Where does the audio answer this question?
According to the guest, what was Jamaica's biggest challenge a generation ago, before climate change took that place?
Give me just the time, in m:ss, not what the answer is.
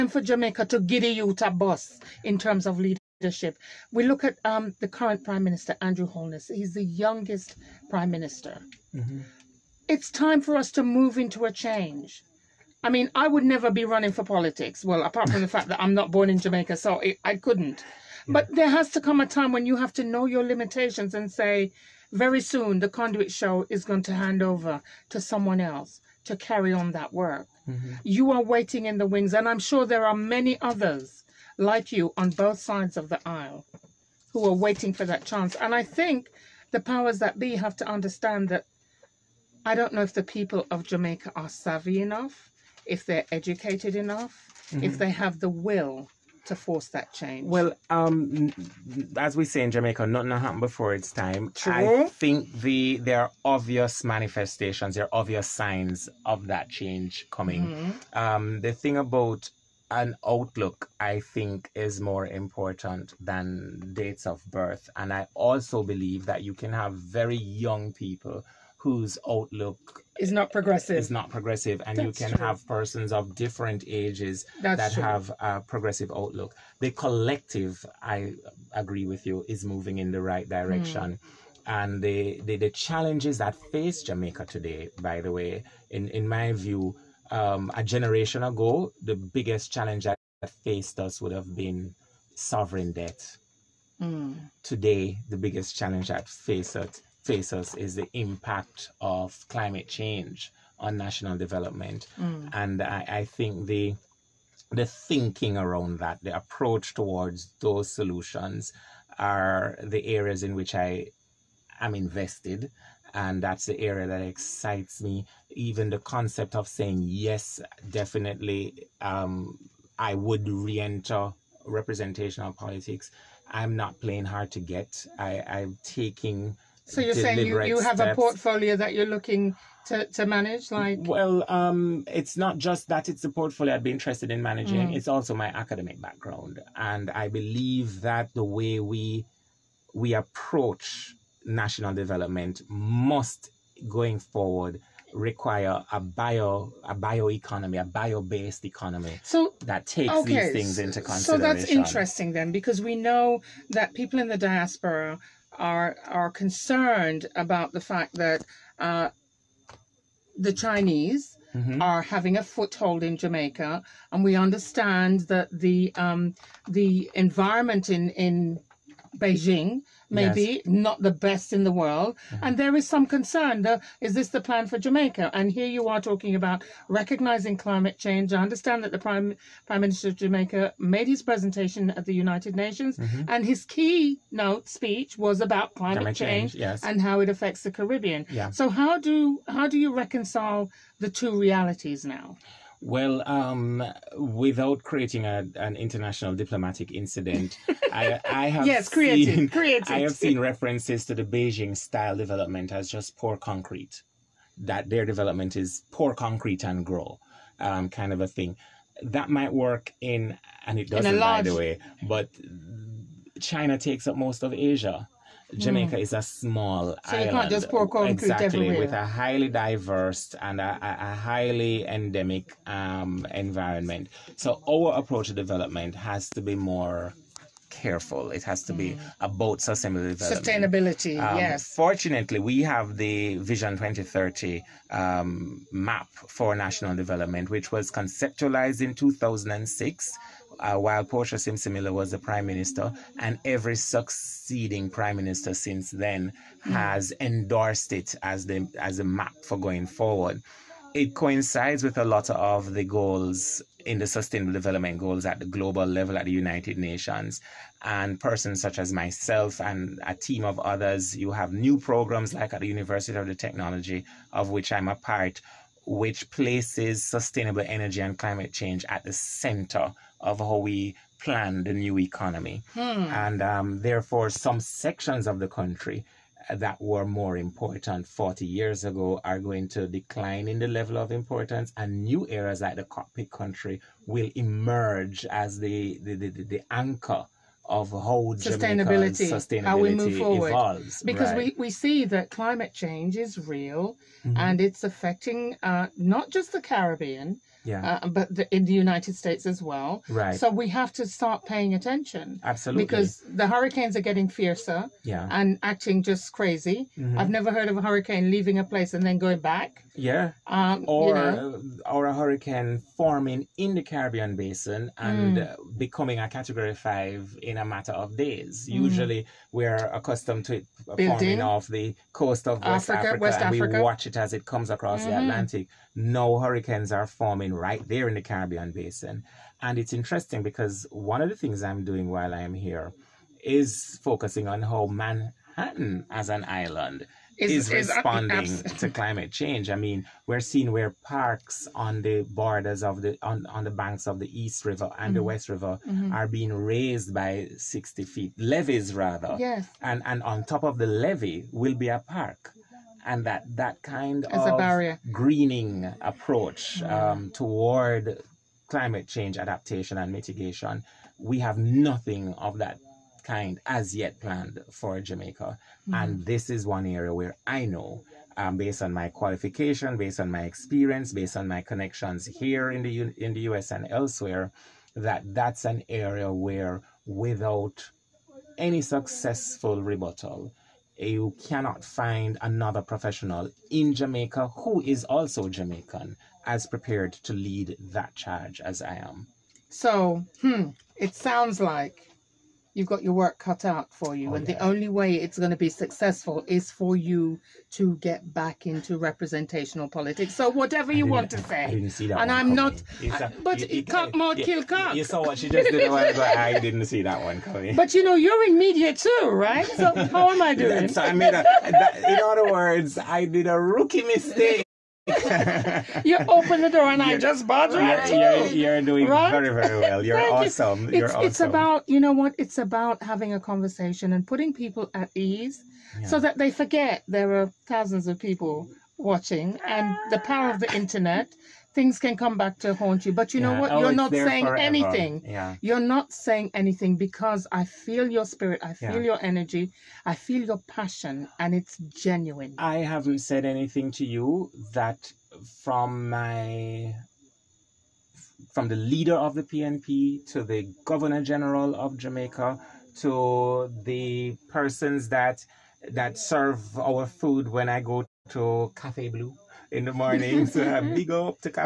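1:32.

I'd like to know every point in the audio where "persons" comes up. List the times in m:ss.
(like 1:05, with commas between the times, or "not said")
1:12, 4:18, 7:34.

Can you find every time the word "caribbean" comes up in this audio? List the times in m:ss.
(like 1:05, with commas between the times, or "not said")
3:07, 4:56, 5:13, 5:28.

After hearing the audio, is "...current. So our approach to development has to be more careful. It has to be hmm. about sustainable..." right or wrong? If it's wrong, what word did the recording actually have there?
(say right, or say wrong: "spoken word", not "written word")
wrong: "environment", not "current".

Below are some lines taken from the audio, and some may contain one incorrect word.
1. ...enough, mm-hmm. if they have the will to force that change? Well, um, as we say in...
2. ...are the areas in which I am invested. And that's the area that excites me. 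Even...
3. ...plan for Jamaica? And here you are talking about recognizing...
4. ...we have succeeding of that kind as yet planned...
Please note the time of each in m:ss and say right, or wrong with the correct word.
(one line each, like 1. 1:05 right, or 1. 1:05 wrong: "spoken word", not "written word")
1. 0:43 right
2. 1:49 right
3. 2:54 right
4. 6:01 wrong: "nothing", not "succeeding".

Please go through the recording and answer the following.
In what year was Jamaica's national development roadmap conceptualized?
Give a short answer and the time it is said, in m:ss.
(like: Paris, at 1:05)
2006, at 3:58.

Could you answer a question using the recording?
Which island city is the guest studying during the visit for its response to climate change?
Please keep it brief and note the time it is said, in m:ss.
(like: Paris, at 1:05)
Manhattan, at 5:34.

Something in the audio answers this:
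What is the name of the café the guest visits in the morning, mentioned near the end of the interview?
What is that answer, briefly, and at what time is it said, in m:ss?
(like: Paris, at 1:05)
Cafe Blue, at 7:38.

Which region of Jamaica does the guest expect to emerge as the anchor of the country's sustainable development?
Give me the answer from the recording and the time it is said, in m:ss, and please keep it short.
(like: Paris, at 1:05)
Cockpit Country, at 4:42.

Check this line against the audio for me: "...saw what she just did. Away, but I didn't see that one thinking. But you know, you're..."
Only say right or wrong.
wrong.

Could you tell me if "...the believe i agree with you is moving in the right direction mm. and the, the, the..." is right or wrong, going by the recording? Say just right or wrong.
wrong.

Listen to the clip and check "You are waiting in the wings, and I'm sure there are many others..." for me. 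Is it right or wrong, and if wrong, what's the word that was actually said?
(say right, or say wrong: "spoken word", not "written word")
right.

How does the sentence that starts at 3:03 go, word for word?
and his keynote speech was about climate, climate change, change yes.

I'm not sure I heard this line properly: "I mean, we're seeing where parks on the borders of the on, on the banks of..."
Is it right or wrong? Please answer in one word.
right.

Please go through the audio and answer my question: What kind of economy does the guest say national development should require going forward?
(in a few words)
Bio-based economy.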